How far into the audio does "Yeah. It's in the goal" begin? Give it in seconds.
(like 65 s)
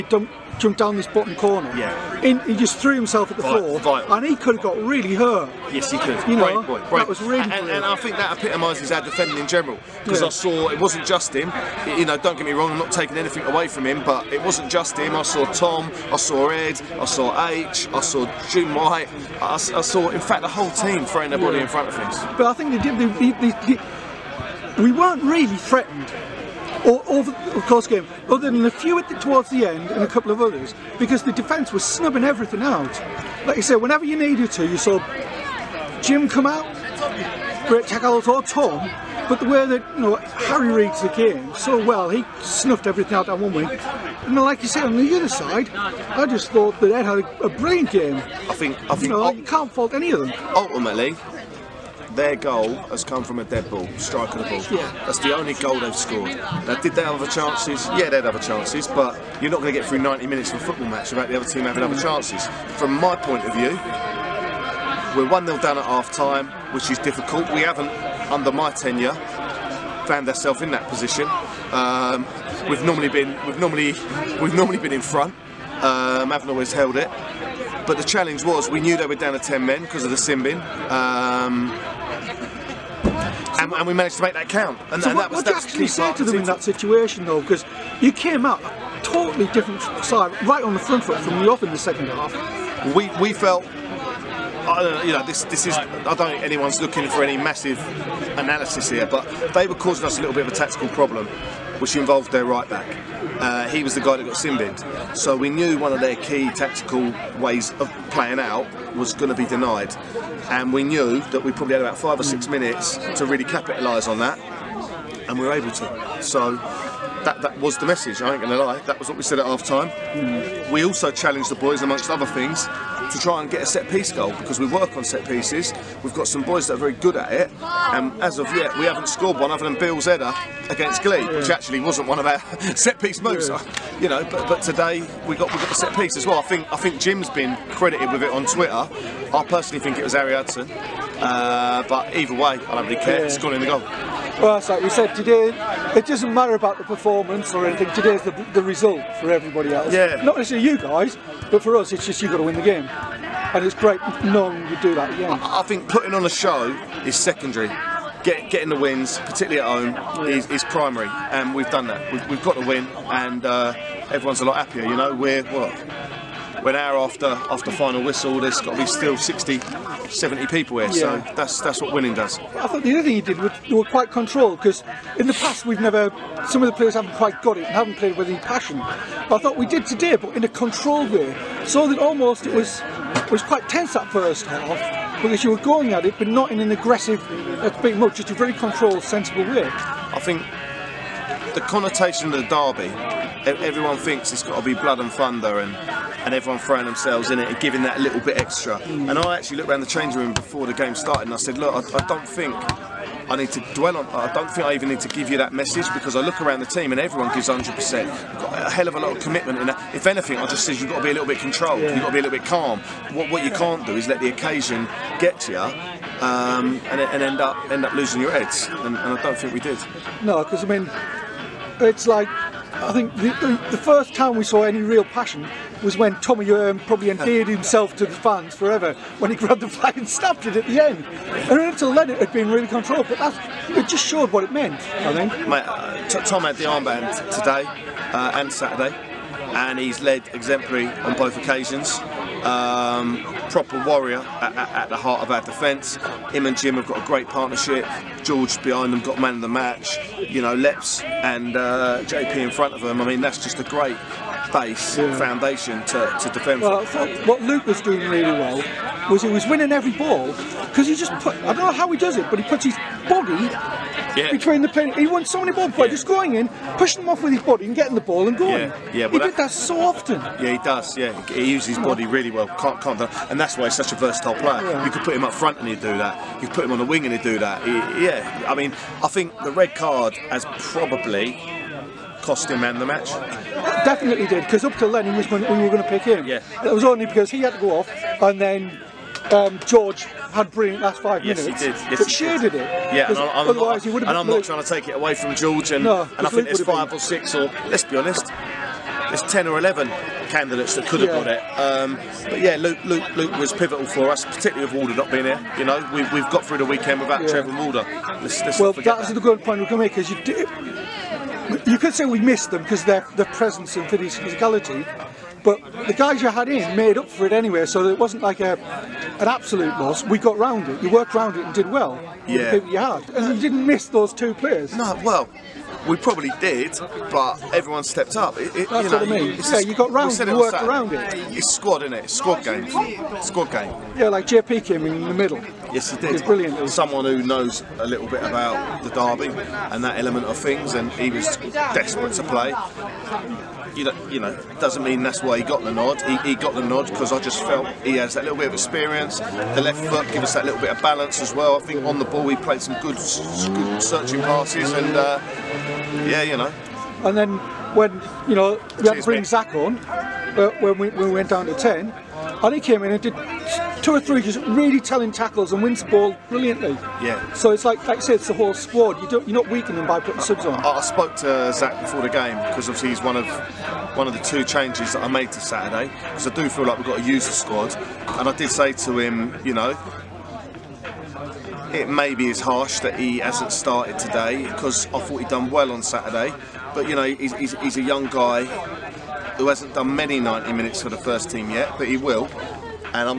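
143 s.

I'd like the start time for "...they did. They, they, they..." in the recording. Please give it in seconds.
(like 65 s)
22 s.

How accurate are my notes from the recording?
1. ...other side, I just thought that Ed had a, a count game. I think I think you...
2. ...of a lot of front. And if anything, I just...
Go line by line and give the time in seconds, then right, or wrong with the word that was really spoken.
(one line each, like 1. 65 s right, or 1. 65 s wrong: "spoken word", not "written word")
1. 45 s wrong: "brilliant", not "count"
2. 208 s wrong: "commitment", not "front".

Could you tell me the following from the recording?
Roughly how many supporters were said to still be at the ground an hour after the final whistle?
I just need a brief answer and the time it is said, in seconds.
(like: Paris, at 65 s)
60 to 70, at 169 s.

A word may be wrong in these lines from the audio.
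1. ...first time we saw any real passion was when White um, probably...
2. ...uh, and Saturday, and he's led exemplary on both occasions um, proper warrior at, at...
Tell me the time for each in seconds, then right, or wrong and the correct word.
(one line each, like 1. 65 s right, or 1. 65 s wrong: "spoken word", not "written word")
1. 223 s wrong: "Tommy", not "White"
2. 238 s right.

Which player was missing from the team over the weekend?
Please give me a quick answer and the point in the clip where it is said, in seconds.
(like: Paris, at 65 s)
Trevor Warder, at 307 s.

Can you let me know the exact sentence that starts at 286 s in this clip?
Yeah, it was only because he had to go off and then um, George had brilliant last five yes, minutes.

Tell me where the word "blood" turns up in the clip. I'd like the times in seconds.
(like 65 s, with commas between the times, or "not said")
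194 s.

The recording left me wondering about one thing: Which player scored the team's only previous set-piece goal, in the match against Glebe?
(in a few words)
Bill Zetter.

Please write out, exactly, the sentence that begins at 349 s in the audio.
The left foot gives us that little bit of balance as well.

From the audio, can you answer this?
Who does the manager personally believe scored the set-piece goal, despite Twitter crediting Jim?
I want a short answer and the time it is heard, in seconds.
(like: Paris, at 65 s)
Harry Hudson, at 140 s.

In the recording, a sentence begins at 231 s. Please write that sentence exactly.
And until then, it had been really controlled, but that it just showed what it meant.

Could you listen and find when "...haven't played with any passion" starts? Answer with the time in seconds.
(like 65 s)
177 s.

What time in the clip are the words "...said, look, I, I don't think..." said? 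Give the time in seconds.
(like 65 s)
201 s.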